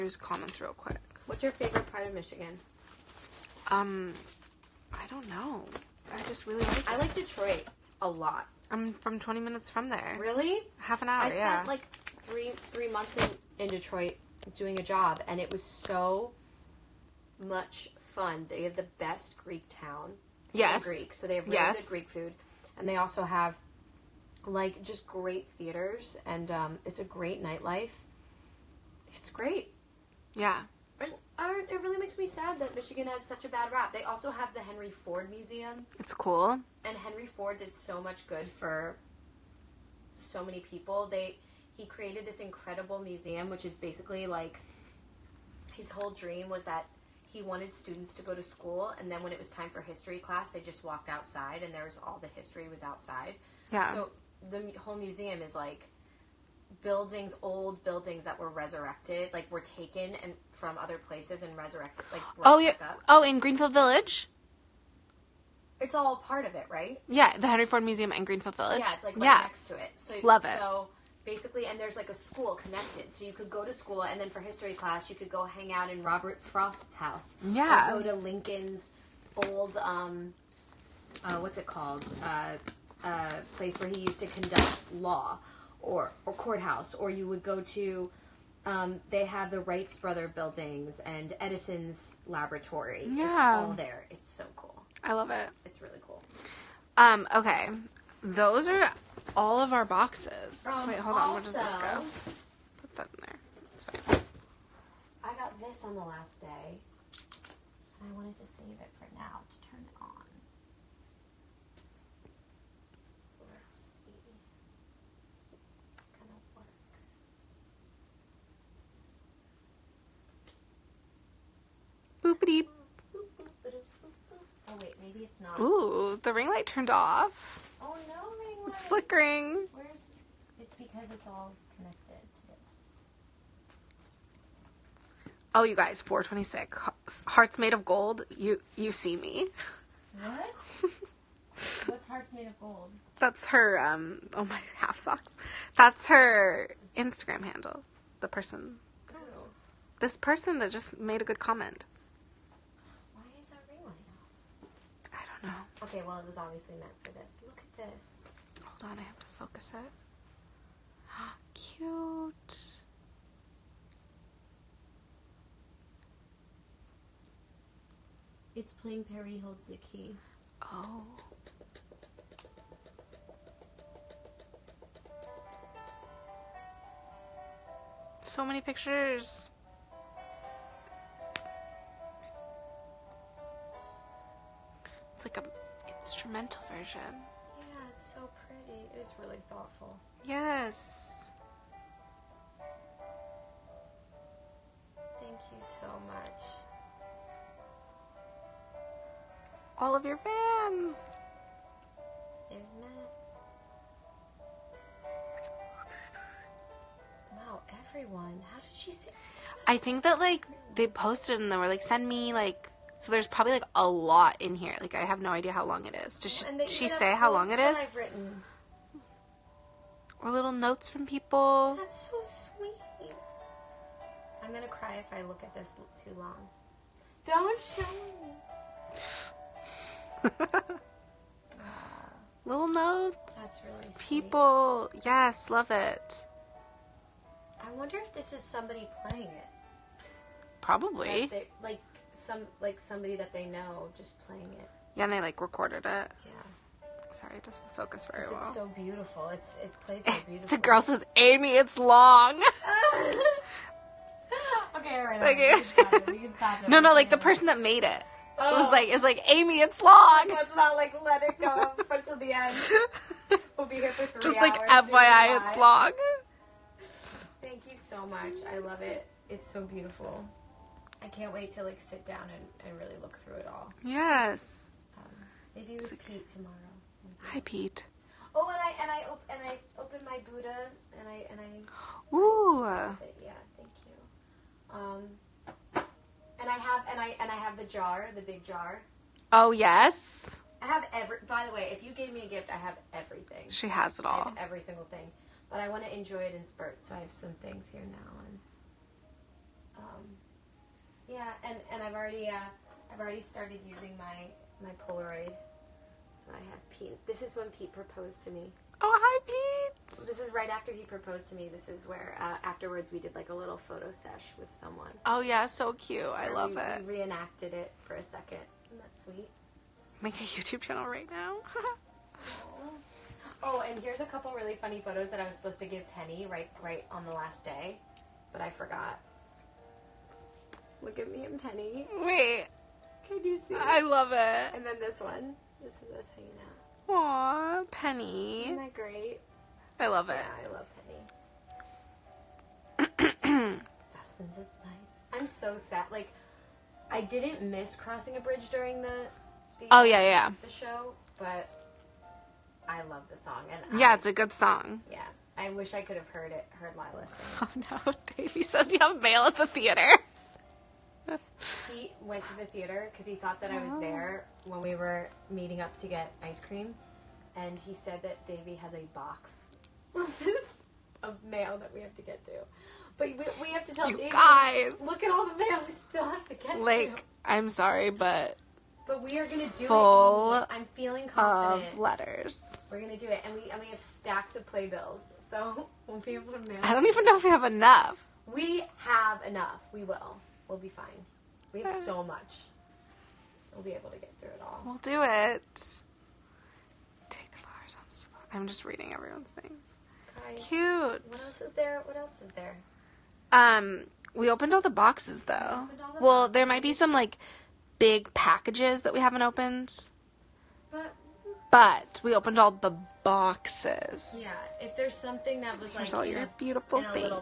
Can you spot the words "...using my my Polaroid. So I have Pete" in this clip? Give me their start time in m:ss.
5:03.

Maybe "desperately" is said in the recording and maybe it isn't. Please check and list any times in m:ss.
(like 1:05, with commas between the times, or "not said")
not said.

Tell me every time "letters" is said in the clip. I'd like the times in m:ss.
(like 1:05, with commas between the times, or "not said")
6:21.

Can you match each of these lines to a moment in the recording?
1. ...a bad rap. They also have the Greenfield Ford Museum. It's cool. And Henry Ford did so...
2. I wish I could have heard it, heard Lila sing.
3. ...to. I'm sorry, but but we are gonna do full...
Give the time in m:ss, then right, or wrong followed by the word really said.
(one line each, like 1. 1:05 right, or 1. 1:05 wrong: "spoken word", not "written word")
1. 0:33 wrong: "Henry", not "Greenfield"
2. 5:55 right
3. 6:16 right.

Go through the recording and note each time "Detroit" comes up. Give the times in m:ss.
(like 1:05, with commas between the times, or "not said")
0:07, 0:13.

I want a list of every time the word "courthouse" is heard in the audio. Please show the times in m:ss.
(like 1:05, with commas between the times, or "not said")
1:26.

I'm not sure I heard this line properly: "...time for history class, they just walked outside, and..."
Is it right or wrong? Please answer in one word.
right.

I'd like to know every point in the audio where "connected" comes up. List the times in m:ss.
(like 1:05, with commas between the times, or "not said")
1:12, 2:11.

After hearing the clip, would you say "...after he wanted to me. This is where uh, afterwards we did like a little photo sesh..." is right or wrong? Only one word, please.
wrong.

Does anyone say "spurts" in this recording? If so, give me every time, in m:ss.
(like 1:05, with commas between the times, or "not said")
4:56.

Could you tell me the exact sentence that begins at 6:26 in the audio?
I don't even know if we have enough.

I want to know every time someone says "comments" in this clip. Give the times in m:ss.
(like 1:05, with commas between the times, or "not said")
0:00, 2:31.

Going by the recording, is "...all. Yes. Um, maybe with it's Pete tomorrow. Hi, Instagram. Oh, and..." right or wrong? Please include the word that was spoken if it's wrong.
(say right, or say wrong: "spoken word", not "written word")
wrong: "Pete", not "Instagram".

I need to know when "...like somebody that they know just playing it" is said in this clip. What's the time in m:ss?
4:02.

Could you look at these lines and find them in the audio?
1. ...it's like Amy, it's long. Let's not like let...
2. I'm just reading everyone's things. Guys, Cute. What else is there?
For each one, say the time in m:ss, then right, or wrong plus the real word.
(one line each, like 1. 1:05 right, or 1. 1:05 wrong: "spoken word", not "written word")
1. 4:18 right
2. 6:38 right.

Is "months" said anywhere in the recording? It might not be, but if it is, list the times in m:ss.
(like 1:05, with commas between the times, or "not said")
0:12.